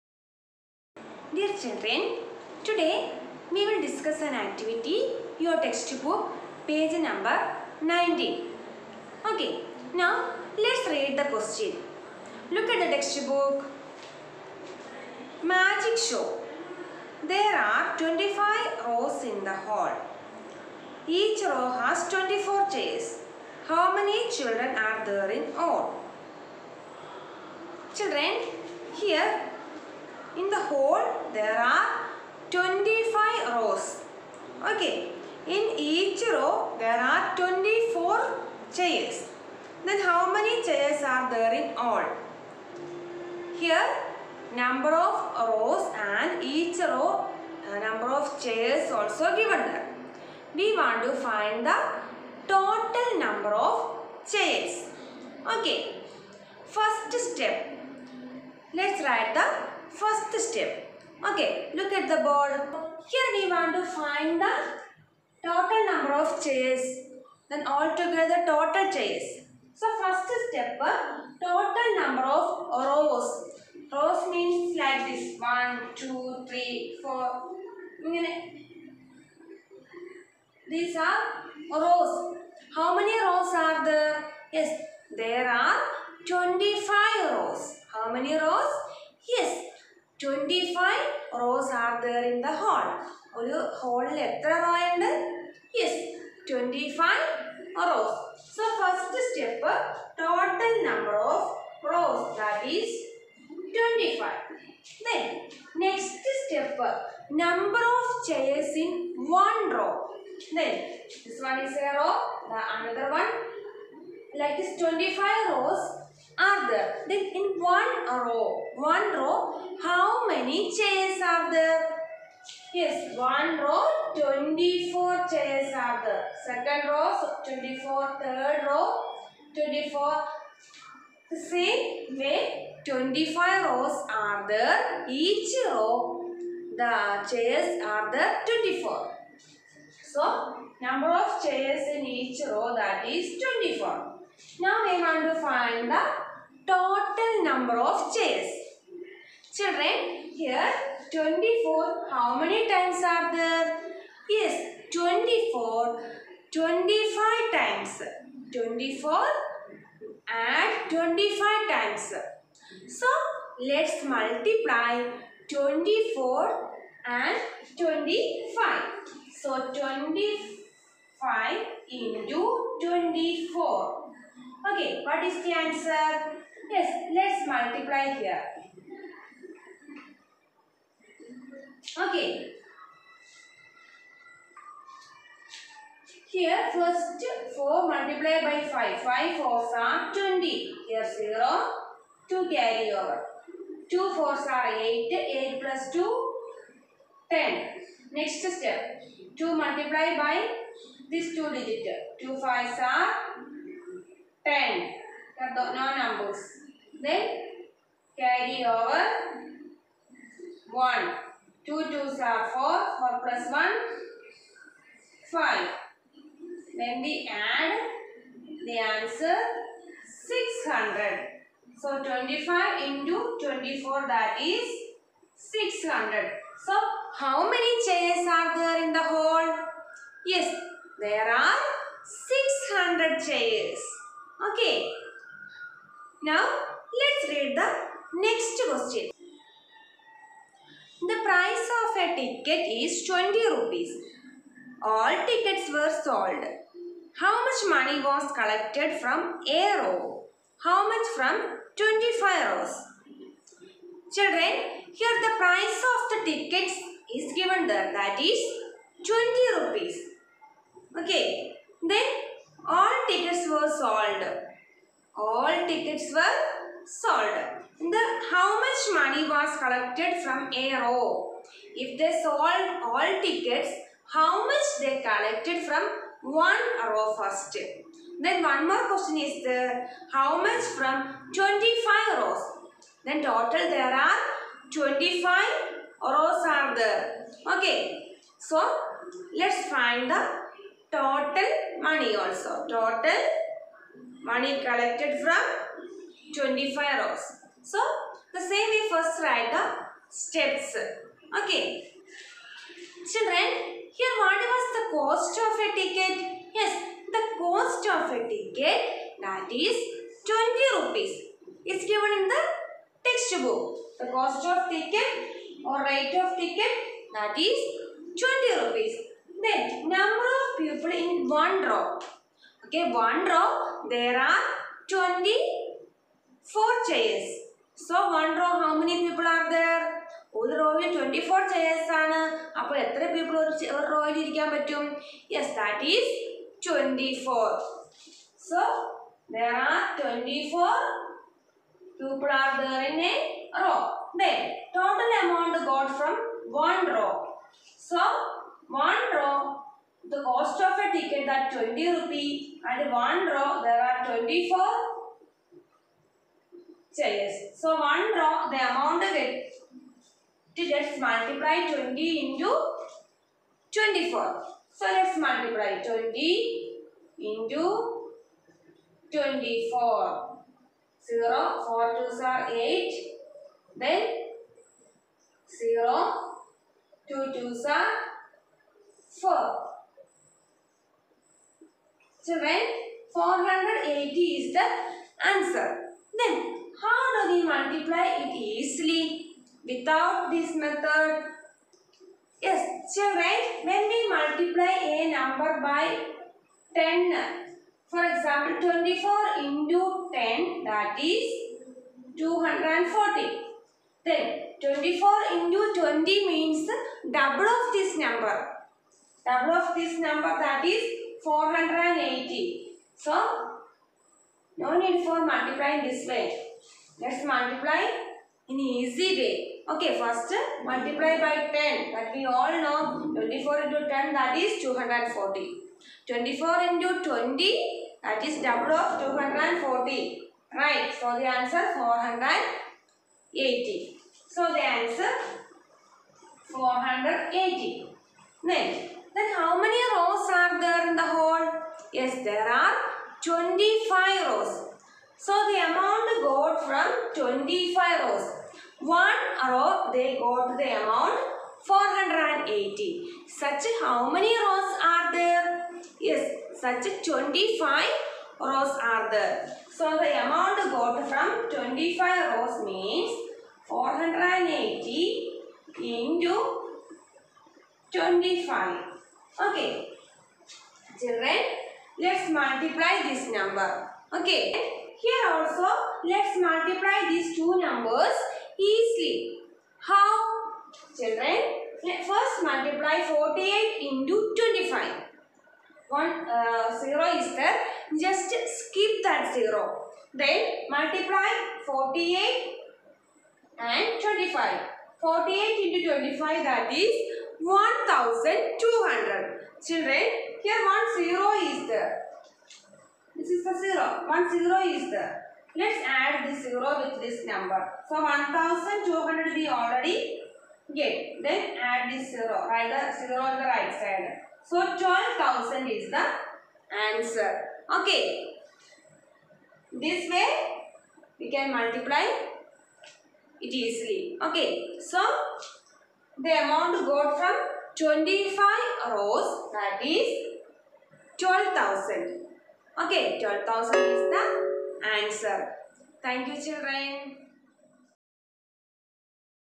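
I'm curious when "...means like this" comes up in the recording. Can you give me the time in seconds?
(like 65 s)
74 s.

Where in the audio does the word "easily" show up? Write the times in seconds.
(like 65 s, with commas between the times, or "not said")
388 s, 478 s, 523 s.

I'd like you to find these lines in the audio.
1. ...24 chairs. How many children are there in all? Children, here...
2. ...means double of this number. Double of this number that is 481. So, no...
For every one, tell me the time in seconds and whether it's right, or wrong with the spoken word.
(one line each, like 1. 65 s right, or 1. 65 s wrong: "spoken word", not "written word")
1. 22 s right
2. 406 s wrong: "480", not "481".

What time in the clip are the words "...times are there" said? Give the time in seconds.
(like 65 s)
152 s.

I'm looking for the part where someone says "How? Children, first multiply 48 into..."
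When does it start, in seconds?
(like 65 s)
479 s.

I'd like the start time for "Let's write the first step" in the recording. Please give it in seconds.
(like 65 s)
58 s.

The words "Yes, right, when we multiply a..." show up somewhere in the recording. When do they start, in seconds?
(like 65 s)
392 s.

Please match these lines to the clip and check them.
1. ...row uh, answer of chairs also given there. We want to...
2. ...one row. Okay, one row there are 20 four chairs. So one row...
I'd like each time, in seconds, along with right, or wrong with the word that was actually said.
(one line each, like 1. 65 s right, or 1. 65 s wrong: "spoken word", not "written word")
1. 46 s wrong: "number", not "answer"
2. 321 s right.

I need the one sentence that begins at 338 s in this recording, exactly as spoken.
So there are twenty-four people are there in a row.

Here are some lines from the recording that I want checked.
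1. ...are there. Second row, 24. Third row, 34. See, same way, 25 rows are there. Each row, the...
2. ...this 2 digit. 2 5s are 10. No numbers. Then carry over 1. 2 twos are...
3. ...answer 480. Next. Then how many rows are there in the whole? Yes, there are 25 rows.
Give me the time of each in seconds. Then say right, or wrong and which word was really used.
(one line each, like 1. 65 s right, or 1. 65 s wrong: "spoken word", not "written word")
1. 125 s wrong: "24", not "34"
2. 201 s right
3. 434 s right.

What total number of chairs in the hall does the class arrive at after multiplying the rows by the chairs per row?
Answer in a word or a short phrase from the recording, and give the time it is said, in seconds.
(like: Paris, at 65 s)
600, at 231 s.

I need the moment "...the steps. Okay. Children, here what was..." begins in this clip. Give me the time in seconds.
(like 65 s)
299 s.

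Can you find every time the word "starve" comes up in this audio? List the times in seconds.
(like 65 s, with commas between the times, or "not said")
not said.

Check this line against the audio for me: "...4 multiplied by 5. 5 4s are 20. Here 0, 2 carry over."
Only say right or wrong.
right.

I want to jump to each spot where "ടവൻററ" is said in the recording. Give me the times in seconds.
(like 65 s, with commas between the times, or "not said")
90 s, 96 s, 103 s, 114 s, 330 s.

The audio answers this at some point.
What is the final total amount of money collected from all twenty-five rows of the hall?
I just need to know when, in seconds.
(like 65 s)
514 s.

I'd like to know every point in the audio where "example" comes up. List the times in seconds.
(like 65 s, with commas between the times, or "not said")
398 s.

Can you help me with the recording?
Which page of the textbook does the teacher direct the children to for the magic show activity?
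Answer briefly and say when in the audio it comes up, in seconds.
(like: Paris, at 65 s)
19, at 6 s.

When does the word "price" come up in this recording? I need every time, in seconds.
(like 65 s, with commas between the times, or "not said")
241 s, 255 s.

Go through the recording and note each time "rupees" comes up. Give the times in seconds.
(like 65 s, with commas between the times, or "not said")
243 s, 259 s, 310 s, 318 s, 351 s.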